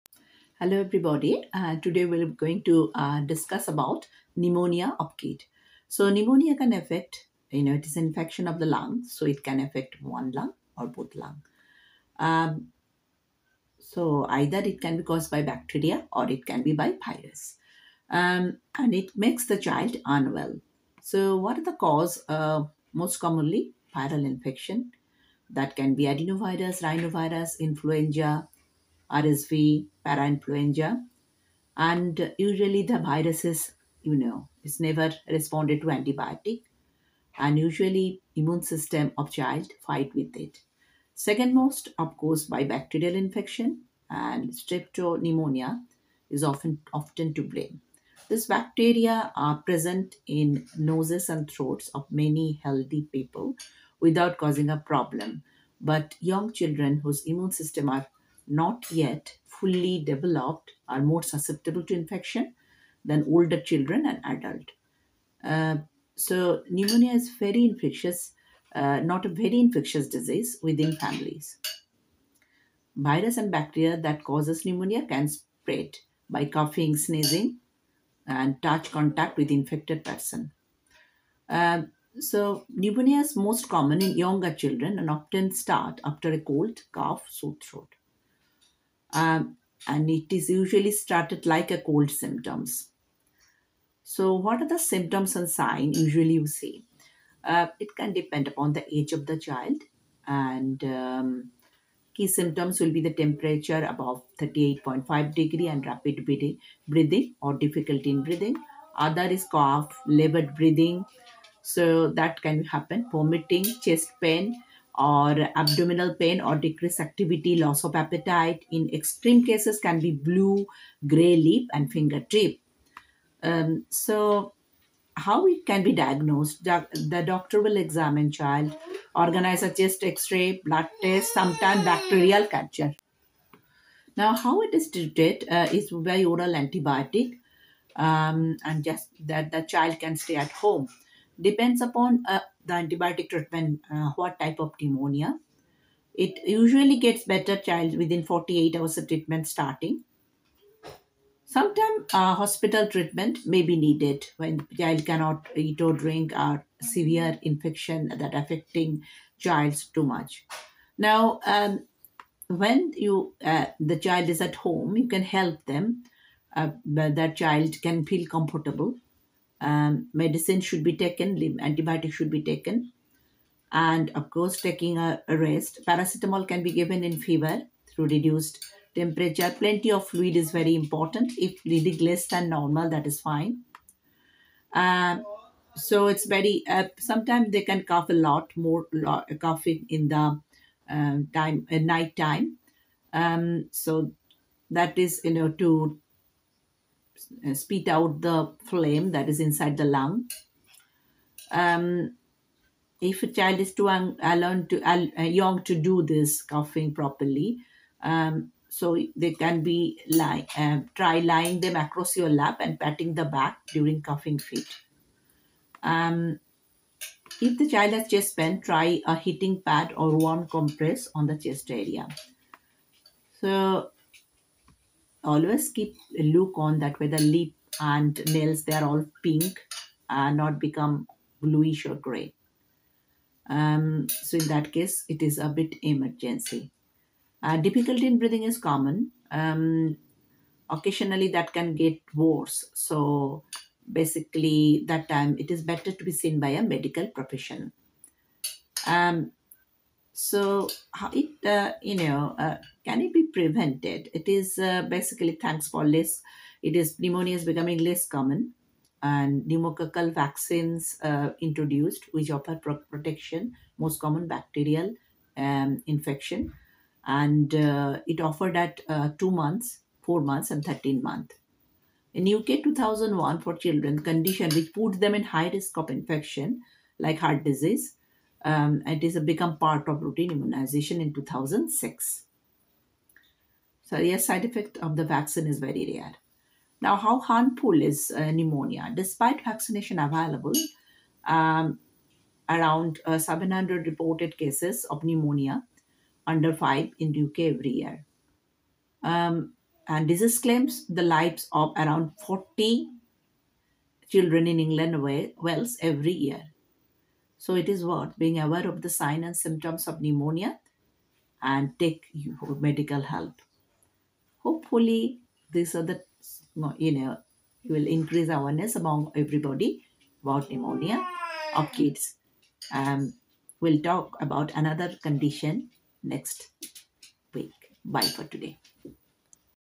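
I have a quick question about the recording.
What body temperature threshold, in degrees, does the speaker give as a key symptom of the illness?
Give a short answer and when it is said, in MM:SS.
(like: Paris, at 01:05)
38.5, at 01:44.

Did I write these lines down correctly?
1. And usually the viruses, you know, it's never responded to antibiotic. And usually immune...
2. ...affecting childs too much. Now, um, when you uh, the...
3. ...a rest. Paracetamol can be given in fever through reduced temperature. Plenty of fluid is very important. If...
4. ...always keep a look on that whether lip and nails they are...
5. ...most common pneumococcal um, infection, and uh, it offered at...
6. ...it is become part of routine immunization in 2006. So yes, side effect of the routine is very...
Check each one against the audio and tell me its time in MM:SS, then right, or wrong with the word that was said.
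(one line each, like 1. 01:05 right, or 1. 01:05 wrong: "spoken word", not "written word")
1. 00:31 right
2. 02:38 right
3. 02:55 right
4. 03:45 right
5. 04:23 wrong: "bacterial", not "pneumococcal"
6. 04:38 wrong: "vaccine", not "routine".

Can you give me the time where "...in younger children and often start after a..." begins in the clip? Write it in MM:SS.
01:24.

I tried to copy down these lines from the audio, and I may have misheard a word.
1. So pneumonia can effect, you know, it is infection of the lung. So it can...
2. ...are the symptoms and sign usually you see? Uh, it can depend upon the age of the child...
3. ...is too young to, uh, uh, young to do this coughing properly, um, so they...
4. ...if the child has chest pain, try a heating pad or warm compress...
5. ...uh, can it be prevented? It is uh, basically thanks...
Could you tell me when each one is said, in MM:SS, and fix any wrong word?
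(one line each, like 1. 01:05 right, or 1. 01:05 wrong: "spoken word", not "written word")
1. 00:05 wrong: "affect", not "effect"
2. 01:34 right
3. 03:23 right
4. 03:37 right
5. 04:12 right.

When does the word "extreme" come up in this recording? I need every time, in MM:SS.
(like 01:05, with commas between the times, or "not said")
01:58.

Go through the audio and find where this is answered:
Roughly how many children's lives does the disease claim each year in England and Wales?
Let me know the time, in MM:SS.
05:02.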